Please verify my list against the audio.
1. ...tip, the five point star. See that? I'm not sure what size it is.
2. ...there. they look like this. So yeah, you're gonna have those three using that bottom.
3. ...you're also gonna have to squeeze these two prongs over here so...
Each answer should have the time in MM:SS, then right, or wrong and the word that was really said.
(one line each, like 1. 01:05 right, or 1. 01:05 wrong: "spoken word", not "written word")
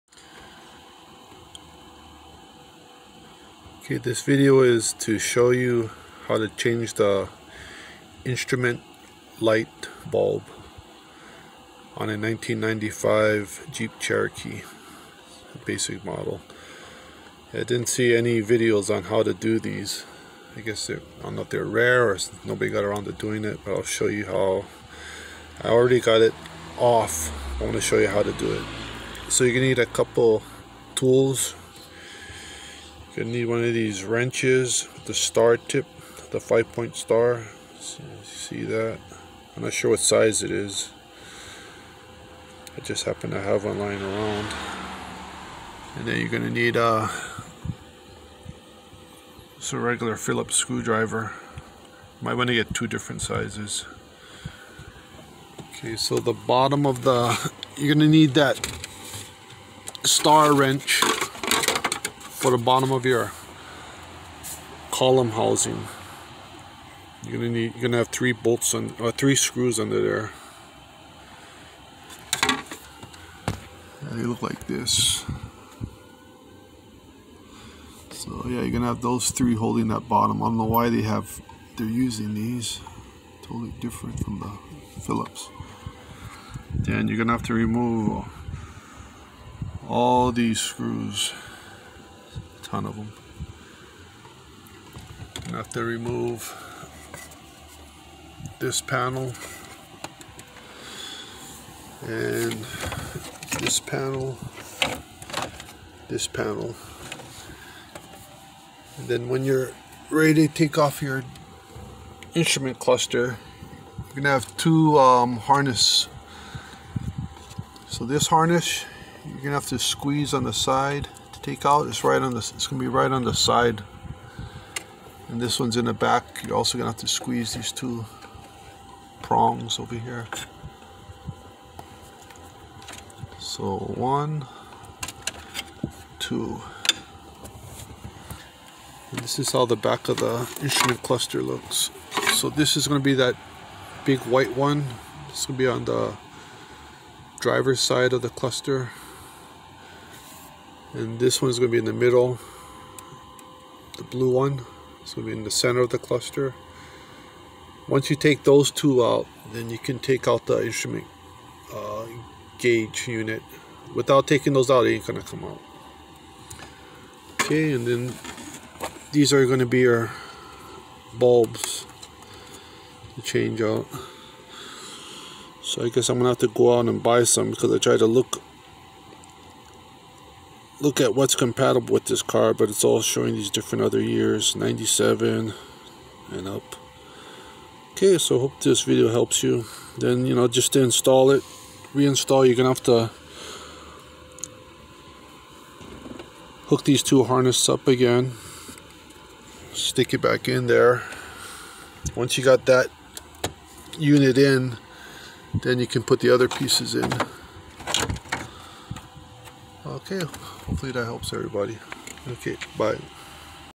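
1. 00:35 right
2. 01:10 wrong: "holding", not "using"
3. 02:06 right.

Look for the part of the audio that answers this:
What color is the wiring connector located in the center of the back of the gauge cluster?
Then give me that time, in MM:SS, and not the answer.
02:34.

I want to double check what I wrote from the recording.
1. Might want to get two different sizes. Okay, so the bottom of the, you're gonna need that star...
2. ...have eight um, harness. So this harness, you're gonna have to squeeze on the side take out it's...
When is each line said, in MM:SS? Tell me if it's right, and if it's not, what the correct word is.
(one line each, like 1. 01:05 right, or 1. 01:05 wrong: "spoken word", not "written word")
1. 00:52 right
2. 01:54 wrong: "two", not "eight".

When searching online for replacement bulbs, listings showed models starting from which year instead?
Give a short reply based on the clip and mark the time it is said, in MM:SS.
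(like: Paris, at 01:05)
1997, at 03:04.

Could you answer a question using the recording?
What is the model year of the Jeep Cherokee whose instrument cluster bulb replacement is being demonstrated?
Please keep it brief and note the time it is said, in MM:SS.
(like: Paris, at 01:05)
1995, at 00:12.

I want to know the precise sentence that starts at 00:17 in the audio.
I didn't see any videos on how to do these.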